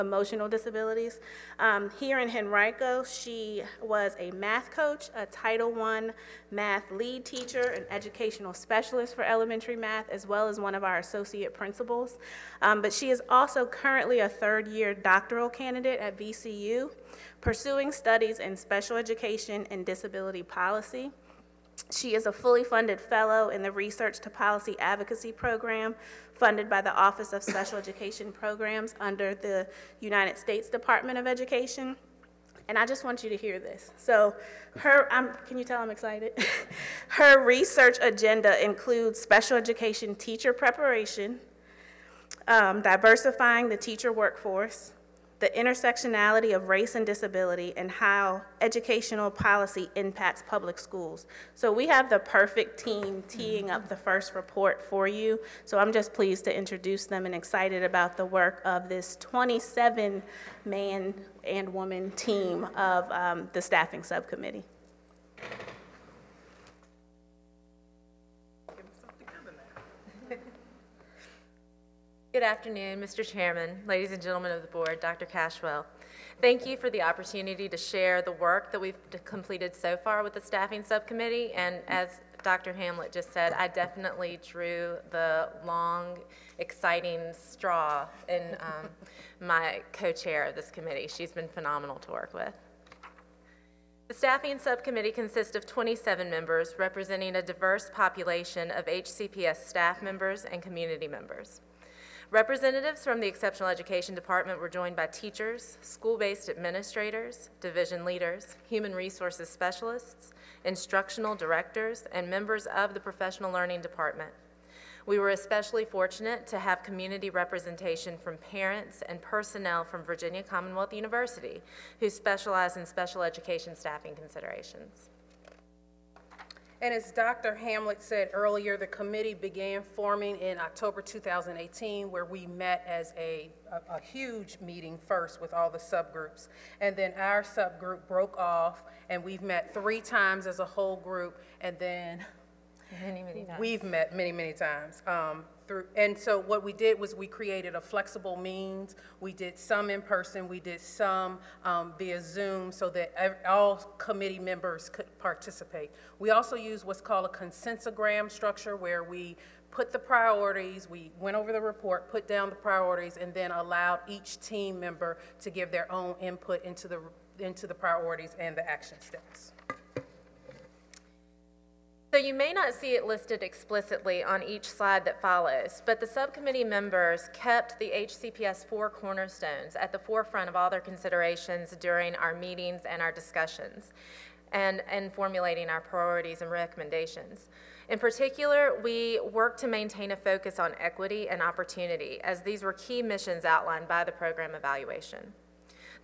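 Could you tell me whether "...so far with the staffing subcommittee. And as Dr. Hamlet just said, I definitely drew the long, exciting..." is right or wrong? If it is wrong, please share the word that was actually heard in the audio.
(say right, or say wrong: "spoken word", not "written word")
right.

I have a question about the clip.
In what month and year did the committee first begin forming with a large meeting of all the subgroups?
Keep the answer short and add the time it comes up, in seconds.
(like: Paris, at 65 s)
October 2018, at 130 s.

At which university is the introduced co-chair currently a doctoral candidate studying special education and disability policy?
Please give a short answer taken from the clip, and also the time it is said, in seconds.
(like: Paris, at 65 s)
VCU, at 16 s.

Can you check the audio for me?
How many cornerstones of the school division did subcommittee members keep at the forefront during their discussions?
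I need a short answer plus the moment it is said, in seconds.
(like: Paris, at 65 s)
4, at 178 s.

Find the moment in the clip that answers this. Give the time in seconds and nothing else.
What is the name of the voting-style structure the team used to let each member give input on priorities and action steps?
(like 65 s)
157 s.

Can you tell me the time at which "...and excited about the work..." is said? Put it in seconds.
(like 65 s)
57 s.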